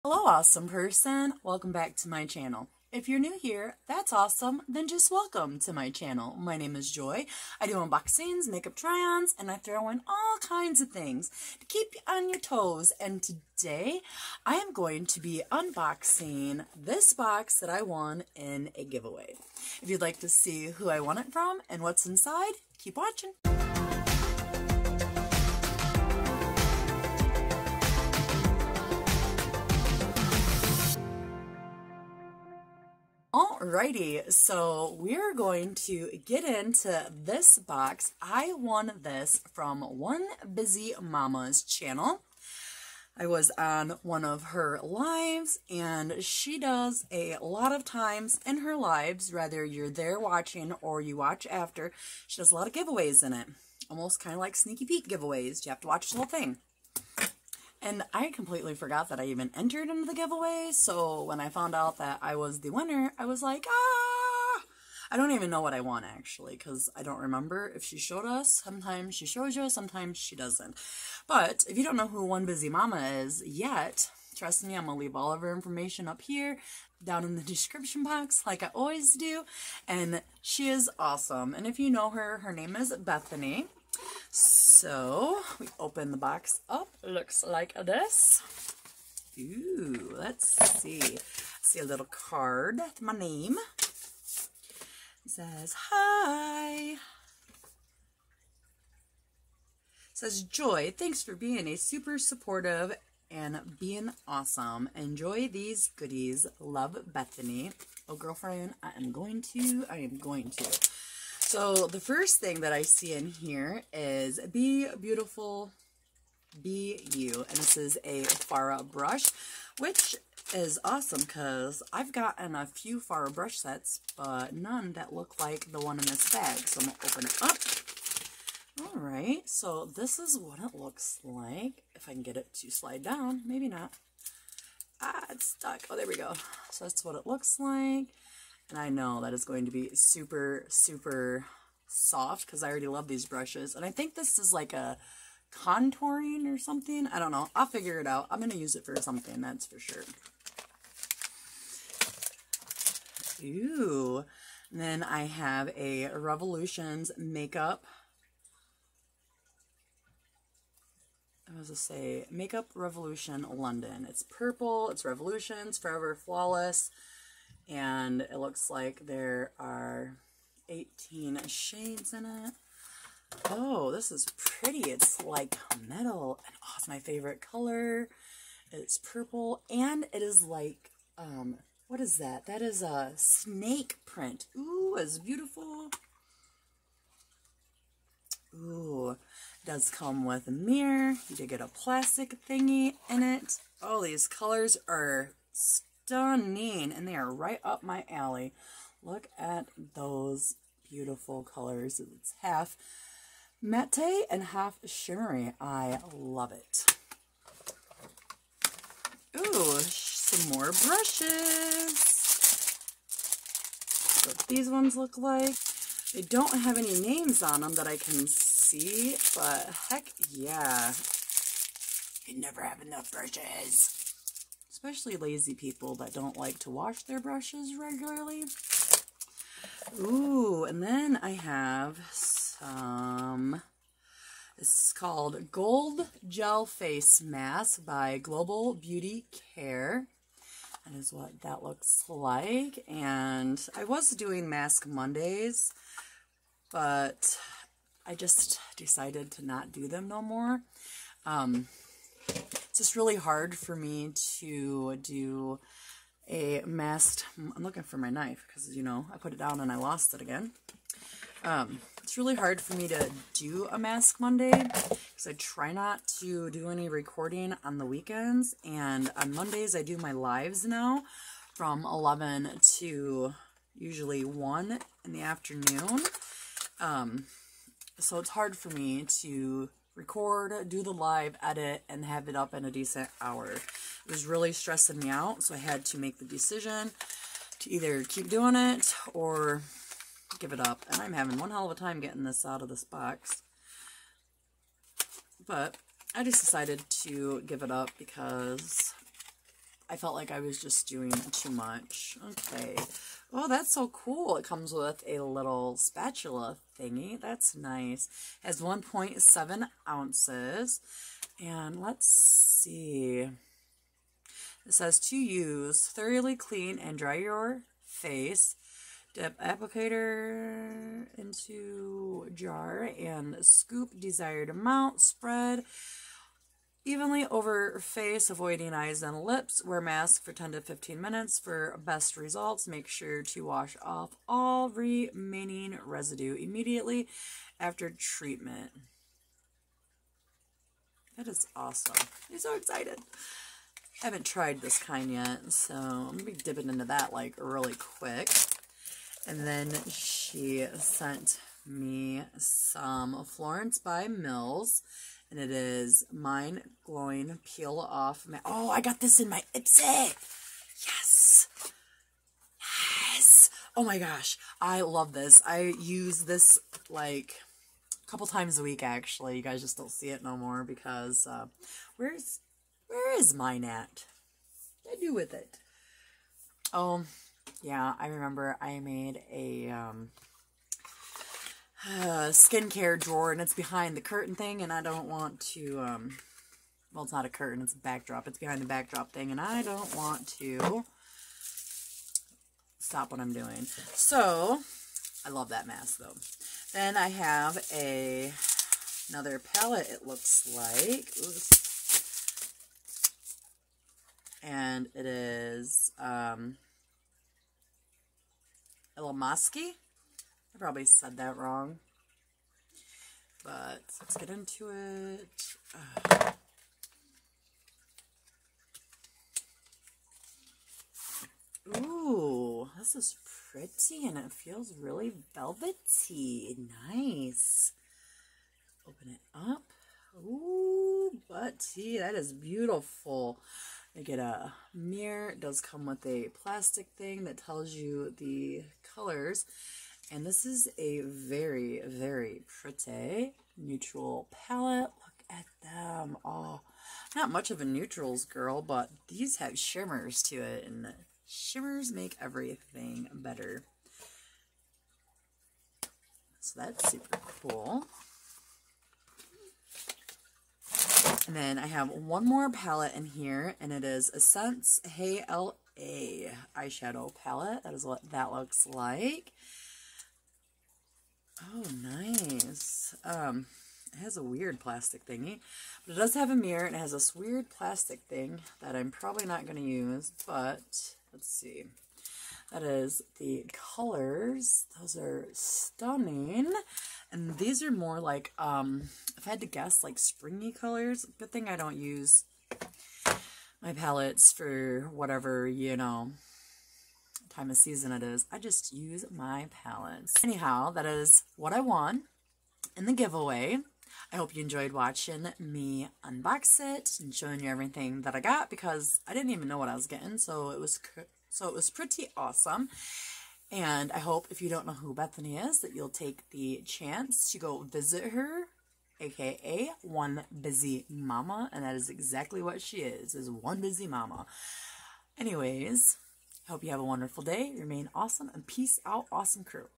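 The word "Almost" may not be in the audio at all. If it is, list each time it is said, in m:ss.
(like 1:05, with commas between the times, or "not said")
0:53.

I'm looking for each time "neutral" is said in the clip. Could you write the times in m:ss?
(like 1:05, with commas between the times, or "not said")
7:23, 7:27.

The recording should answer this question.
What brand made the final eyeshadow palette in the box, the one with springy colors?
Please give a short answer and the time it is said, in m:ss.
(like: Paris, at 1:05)
Essence, at 7:44.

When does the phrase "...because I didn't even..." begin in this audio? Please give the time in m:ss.
8:28.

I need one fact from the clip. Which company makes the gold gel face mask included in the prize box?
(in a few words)
Global Beauty Care.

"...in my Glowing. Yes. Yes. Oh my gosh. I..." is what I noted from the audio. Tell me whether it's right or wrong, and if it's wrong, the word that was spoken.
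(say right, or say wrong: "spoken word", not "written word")
wrong: "Ipsy", not "Glowing".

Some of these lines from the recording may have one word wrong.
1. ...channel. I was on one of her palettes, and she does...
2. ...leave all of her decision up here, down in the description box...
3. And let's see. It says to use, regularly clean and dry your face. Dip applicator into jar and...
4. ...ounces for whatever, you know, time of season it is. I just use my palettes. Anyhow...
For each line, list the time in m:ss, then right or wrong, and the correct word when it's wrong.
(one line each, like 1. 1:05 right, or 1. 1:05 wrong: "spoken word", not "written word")
1. 0:41 wrong: "lives", not "palettes"
2. 1:14 wrong: "information", not "decision"
3. 5:11 wrong: "thoroughly", not "regularly"
4. 8:13 wrong: "palettes", not "ounces".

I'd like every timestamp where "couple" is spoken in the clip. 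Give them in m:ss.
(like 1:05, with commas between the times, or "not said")
6:08.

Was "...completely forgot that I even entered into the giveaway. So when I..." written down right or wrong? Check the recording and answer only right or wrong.
right.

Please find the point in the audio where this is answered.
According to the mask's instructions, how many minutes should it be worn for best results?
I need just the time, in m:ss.
5:30.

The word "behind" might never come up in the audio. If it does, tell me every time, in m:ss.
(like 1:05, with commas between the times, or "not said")
6:23, 6:28.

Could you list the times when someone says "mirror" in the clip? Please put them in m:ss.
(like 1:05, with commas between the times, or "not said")
3:10, 7:14, 7:56.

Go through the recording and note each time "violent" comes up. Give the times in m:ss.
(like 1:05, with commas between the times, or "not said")
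not said.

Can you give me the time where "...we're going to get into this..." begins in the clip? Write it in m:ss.
0:34.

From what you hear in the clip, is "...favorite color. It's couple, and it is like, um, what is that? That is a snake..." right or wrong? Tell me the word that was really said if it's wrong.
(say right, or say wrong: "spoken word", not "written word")
wrong: "purple", not "couple".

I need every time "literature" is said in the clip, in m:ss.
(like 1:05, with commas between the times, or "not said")
not said.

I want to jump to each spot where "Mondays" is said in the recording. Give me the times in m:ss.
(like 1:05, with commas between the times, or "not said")
4:04, 4:24, 4:29.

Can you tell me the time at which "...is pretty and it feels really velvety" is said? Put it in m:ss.
7:02.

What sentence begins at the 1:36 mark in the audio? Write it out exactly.
It says, Joy, thanks for being a super supportive and being awesome.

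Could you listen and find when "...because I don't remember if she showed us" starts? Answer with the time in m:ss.
1:06.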